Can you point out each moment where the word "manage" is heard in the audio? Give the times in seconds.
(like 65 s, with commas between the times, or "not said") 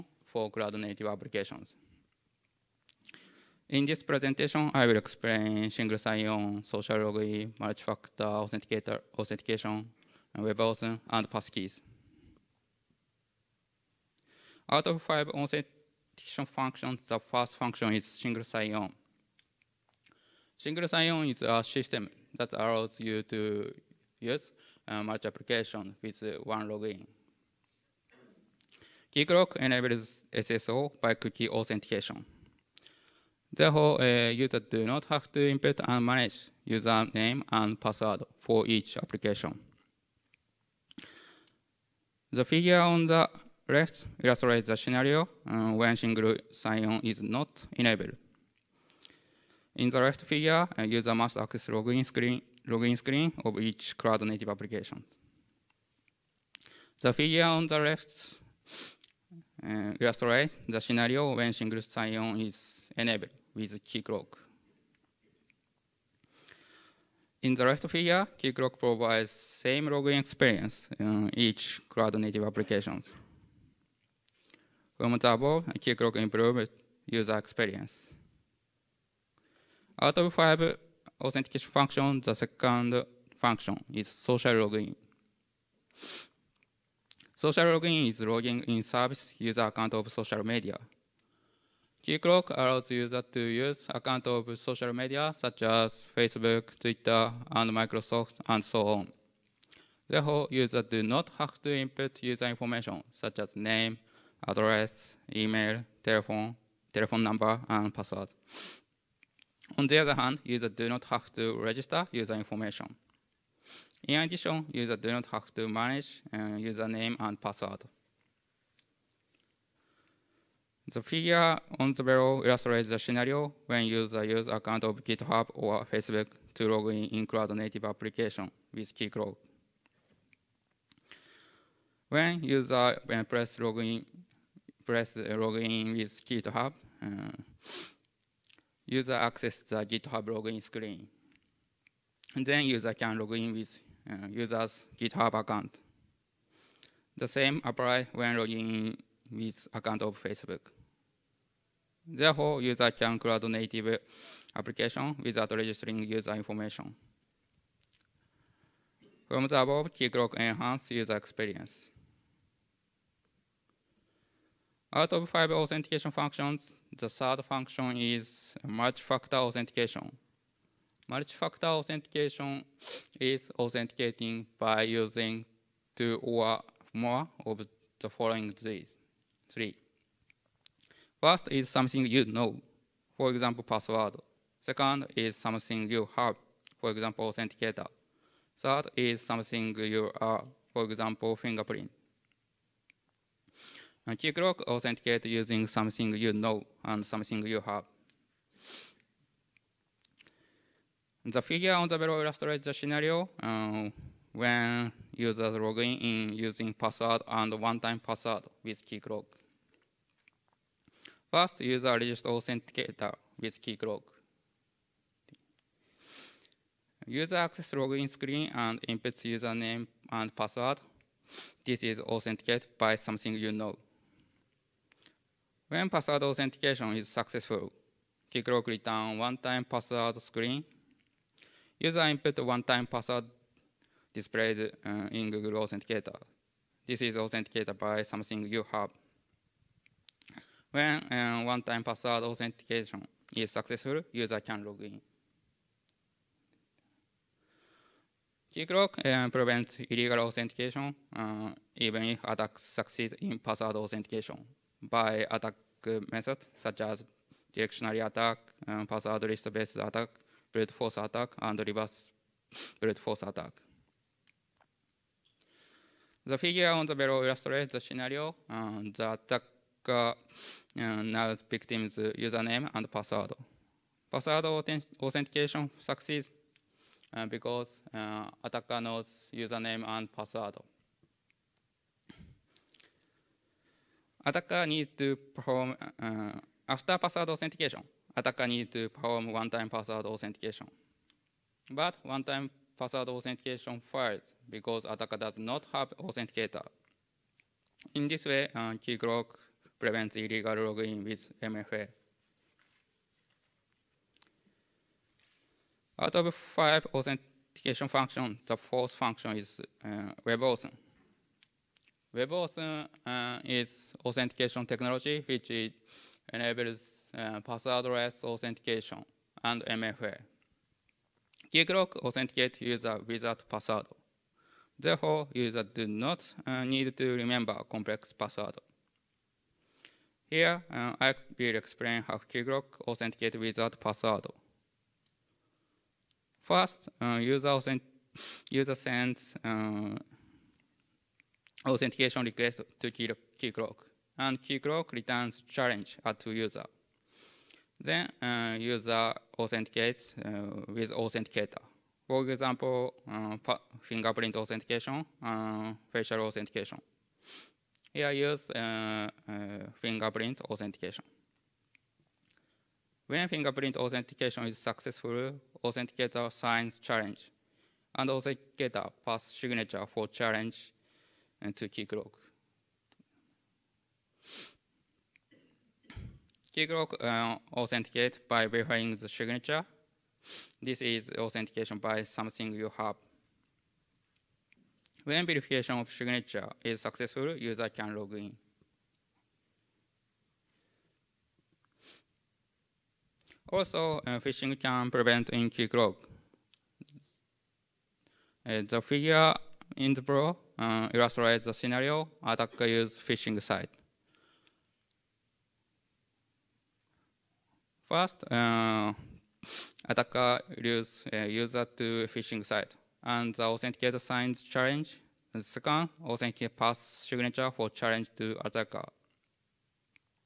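36 s, 115 s.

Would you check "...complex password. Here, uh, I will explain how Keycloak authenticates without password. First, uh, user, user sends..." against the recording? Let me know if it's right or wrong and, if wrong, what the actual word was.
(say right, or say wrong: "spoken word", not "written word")
right.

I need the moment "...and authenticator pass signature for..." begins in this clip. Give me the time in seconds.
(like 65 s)
367 s.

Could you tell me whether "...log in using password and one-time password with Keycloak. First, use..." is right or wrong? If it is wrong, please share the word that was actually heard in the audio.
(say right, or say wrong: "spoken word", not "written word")
right.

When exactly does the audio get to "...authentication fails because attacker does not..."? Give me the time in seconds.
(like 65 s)
293 s.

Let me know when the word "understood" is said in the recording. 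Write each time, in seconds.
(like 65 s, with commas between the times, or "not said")
not said.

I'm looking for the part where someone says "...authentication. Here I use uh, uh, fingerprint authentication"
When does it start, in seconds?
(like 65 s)
356 s.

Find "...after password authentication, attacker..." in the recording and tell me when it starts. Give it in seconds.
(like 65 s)
286 s.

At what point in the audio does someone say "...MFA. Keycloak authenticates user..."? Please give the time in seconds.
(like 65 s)
319 s.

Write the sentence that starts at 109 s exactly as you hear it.
On the other hand, users do not have to register user information.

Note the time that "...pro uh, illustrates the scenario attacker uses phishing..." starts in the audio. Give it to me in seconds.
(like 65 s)
400 s.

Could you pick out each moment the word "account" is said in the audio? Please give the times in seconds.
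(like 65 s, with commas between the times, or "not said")
89 s, 93 s, 124 s, 145 s, 149 s.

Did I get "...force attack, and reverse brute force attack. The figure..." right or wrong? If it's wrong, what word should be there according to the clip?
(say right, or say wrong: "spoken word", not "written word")
right.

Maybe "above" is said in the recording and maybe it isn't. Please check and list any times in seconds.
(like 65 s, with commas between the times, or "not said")
75 s, 159 s.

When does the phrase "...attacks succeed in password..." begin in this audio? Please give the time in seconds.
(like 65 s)
252 s.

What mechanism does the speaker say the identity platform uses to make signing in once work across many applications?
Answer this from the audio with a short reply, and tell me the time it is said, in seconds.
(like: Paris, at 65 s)
cookie authentication, at 31 s.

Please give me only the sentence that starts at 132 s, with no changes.
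When user when press login, press login with GitHub, uh, user access the GitHub login screen.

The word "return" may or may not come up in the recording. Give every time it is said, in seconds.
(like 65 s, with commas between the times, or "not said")
228 s, 344 s.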